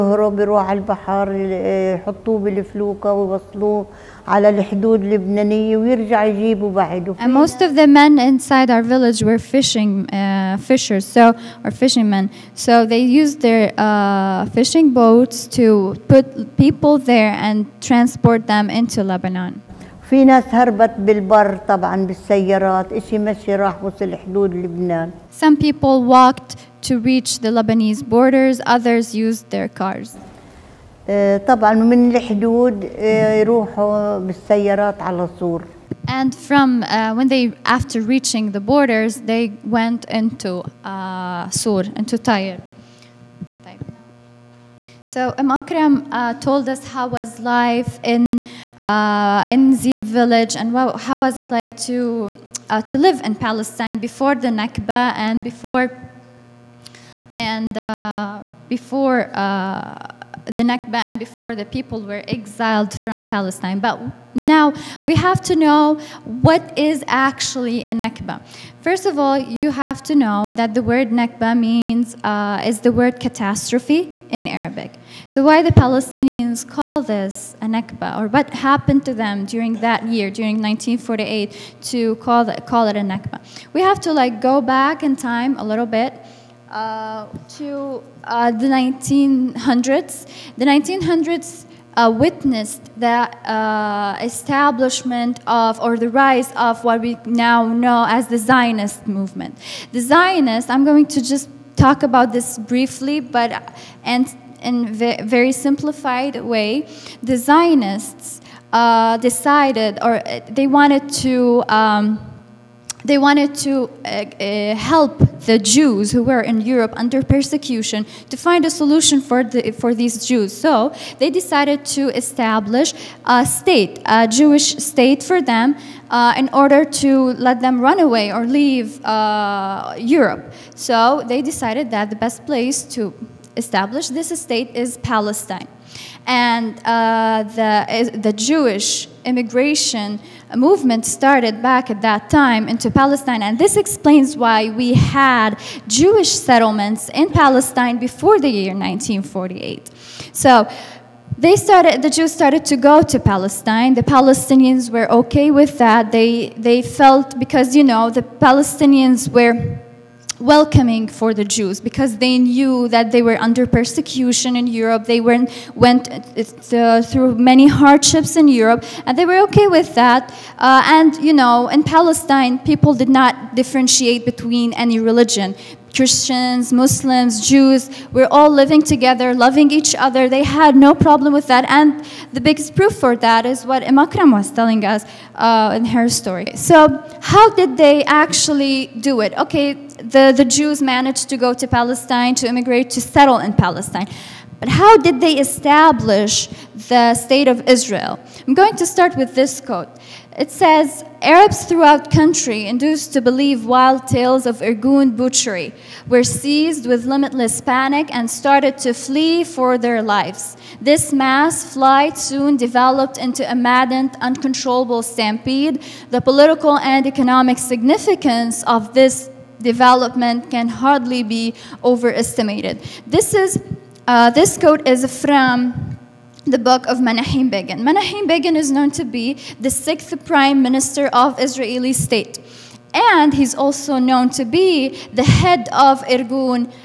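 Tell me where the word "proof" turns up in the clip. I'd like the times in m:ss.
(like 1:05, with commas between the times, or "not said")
3:02.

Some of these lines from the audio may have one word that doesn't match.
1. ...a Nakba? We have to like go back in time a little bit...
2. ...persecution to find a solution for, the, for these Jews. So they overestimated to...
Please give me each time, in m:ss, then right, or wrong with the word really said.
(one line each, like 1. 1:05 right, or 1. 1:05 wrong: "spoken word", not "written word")
1. 1:22 right
2. 1:57 wrong: "decided", not "overestimated".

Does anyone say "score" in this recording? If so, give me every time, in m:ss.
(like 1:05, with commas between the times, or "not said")
not said.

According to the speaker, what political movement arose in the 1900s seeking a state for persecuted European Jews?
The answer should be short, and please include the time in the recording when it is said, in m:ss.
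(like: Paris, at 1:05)
Zionist movement, at 1:38.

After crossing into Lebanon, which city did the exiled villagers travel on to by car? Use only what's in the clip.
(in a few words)
Tyre.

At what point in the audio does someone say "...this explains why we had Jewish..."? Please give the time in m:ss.
2:23.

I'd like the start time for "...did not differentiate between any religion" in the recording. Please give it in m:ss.
2:52.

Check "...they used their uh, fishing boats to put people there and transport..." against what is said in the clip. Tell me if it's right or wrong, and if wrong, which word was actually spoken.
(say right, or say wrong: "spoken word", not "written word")
right.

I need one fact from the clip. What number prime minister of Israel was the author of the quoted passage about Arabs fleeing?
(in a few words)
sixth.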